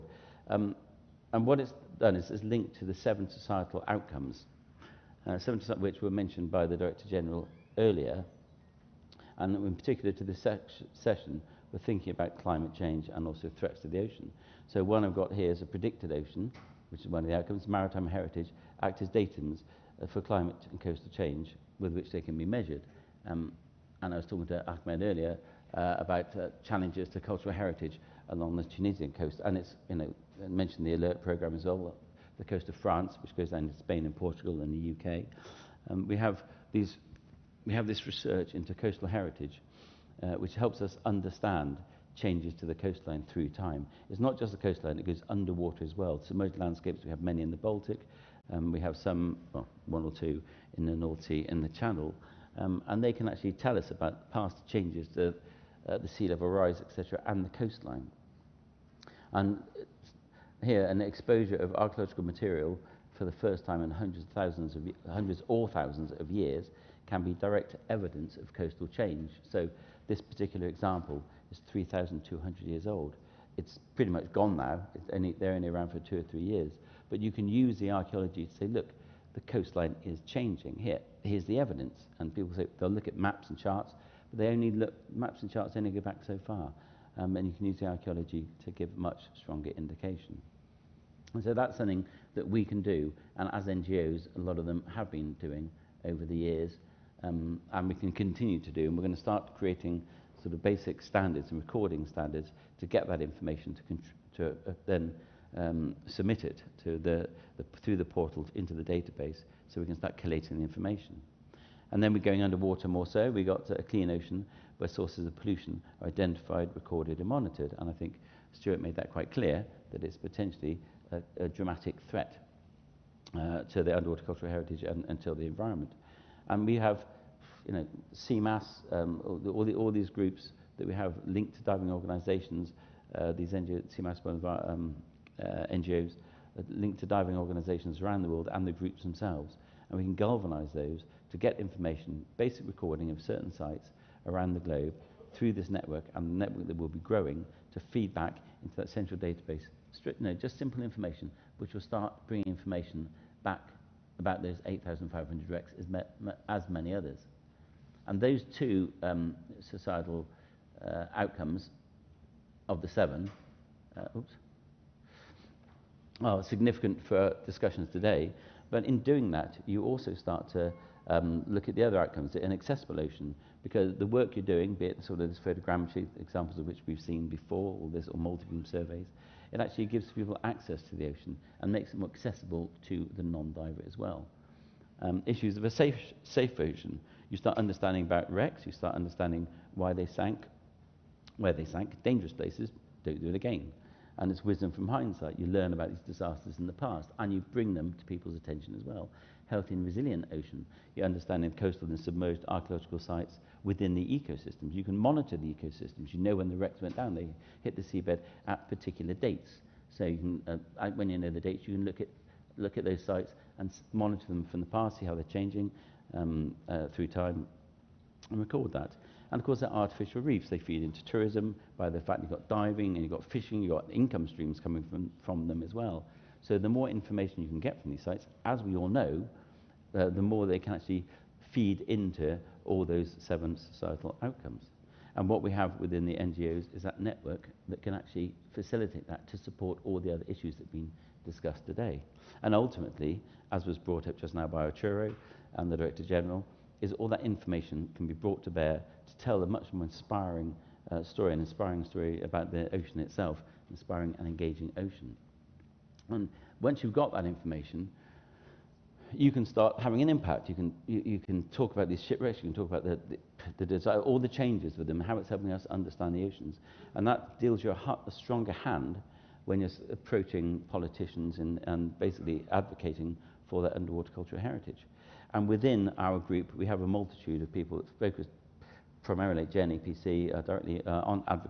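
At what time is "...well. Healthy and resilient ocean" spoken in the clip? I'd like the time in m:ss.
3:18.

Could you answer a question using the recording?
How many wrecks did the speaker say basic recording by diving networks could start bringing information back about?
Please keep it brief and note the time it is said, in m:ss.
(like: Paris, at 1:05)
8,500, at 2:34.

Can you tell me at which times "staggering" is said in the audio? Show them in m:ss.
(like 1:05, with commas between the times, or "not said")
not said.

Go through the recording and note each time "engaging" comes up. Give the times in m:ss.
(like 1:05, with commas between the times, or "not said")
4:14.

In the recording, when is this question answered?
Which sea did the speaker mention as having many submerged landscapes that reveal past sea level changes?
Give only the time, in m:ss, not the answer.
0:47.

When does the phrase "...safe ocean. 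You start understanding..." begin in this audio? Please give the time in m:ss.
3:06.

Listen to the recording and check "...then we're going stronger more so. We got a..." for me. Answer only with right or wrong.
wrong.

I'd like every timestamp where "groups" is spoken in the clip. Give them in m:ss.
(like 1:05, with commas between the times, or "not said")
2:10, 2:18, 4:36.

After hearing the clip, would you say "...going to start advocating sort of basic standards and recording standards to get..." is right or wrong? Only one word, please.
wrong.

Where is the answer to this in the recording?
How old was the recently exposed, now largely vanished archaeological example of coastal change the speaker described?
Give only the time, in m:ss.
1:11.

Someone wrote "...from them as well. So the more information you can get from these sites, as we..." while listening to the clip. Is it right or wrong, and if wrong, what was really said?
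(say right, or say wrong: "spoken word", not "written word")
right.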